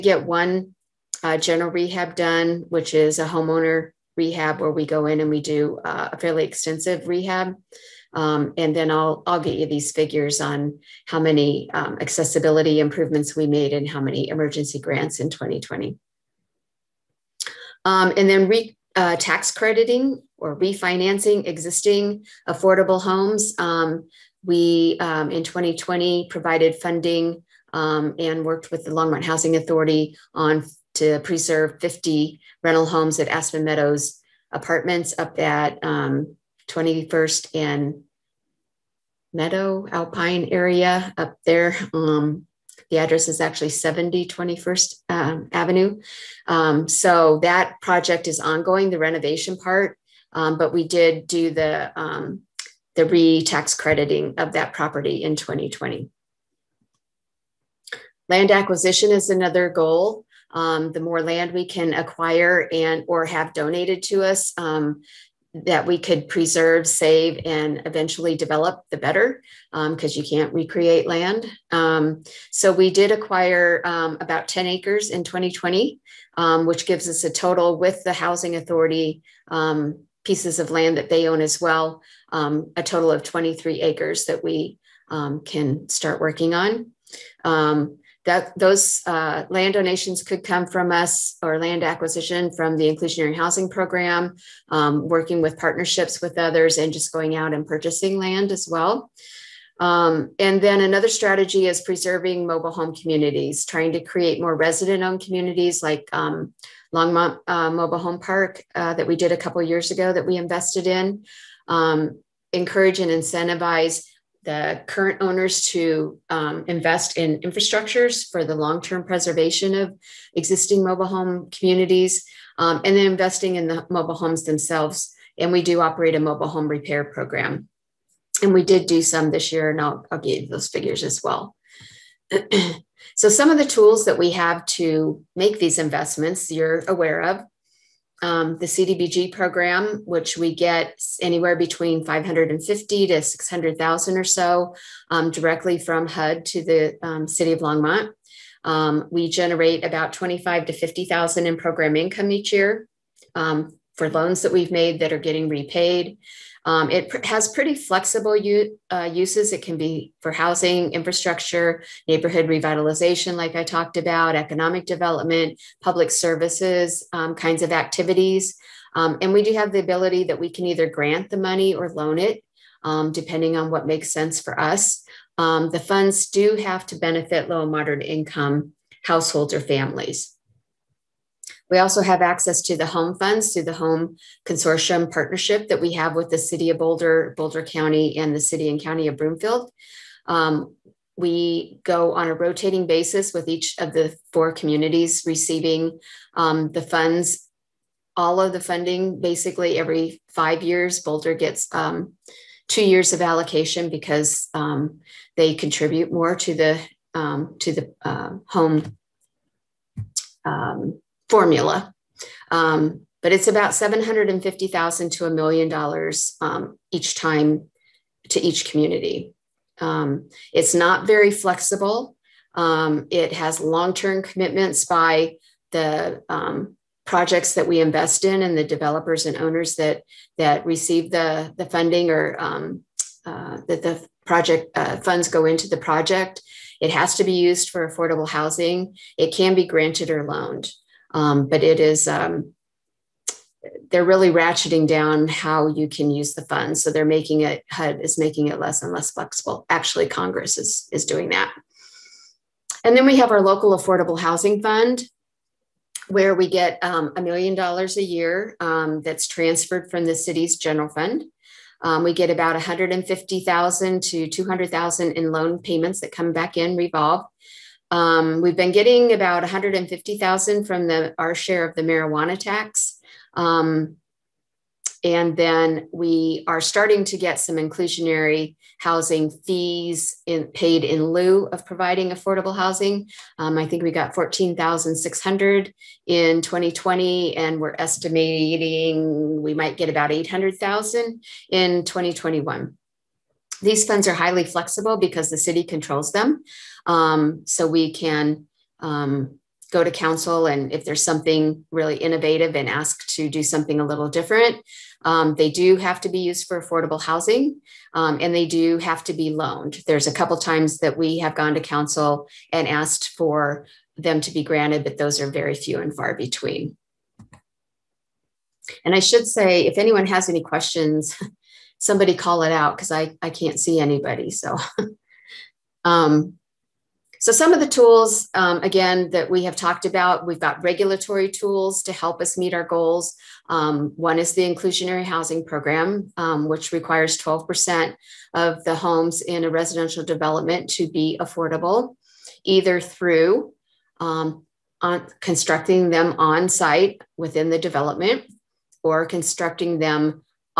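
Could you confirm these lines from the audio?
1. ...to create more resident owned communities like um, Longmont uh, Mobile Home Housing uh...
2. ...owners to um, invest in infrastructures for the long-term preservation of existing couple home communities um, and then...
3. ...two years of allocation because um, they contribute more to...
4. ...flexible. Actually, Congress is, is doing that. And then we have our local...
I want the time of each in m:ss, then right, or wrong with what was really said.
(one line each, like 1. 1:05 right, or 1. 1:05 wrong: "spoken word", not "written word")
1. 1:43 wrong: "Park", not "Housing"
2. 1:55 wrong: "mobile", not "couple"
3. 3:22 right
4. 4:09 right.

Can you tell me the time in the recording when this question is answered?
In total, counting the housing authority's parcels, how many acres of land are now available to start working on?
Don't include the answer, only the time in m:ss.
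1:23.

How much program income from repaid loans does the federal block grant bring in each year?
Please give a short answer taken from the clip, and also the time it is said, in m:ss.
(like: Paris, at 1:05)
25 to 50,000, at 2:30.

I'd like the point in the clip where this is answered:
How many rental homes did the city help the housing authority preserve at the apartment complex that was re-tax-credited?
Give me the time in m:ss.
0:31.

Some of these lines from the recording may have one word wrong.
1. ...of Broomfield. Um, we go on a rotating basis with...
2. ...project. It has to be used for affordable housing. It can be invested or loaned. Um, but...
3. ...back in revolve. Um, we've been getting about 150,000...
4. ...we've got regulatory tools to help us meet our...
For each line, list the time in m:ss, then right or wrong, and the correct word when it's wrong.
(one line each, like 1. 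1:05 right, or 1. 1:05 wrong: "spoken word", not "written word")
1. 3:09 right
2. 3:55 wrong: "granted", not "invested"
3. 4:26 right
4. 5:30 right.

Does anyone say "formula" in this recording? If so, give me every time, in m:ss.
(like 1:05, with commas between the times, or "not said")
3:31.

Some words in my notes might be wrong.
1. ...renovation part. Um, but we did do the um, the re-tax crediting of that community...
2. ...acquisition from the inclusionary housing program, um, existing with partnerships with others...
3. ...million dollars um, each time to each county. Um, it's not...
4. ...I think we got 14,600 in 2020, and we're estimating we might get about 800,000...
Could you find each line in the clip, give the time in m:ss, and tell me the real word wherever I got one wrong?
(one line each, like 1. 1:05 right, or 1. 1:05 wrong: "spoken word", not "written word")
1. 0:48 wrong: "property", not "community"
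2. 1:31 wrong: "working", not "existing"
3. 3:35 wrong: "community", not "county"
4. 4:43 right.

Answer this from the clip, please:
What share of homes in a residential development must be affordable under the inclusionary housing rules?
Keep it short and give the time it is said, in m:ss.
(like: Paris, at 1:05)
12%, at 5:37.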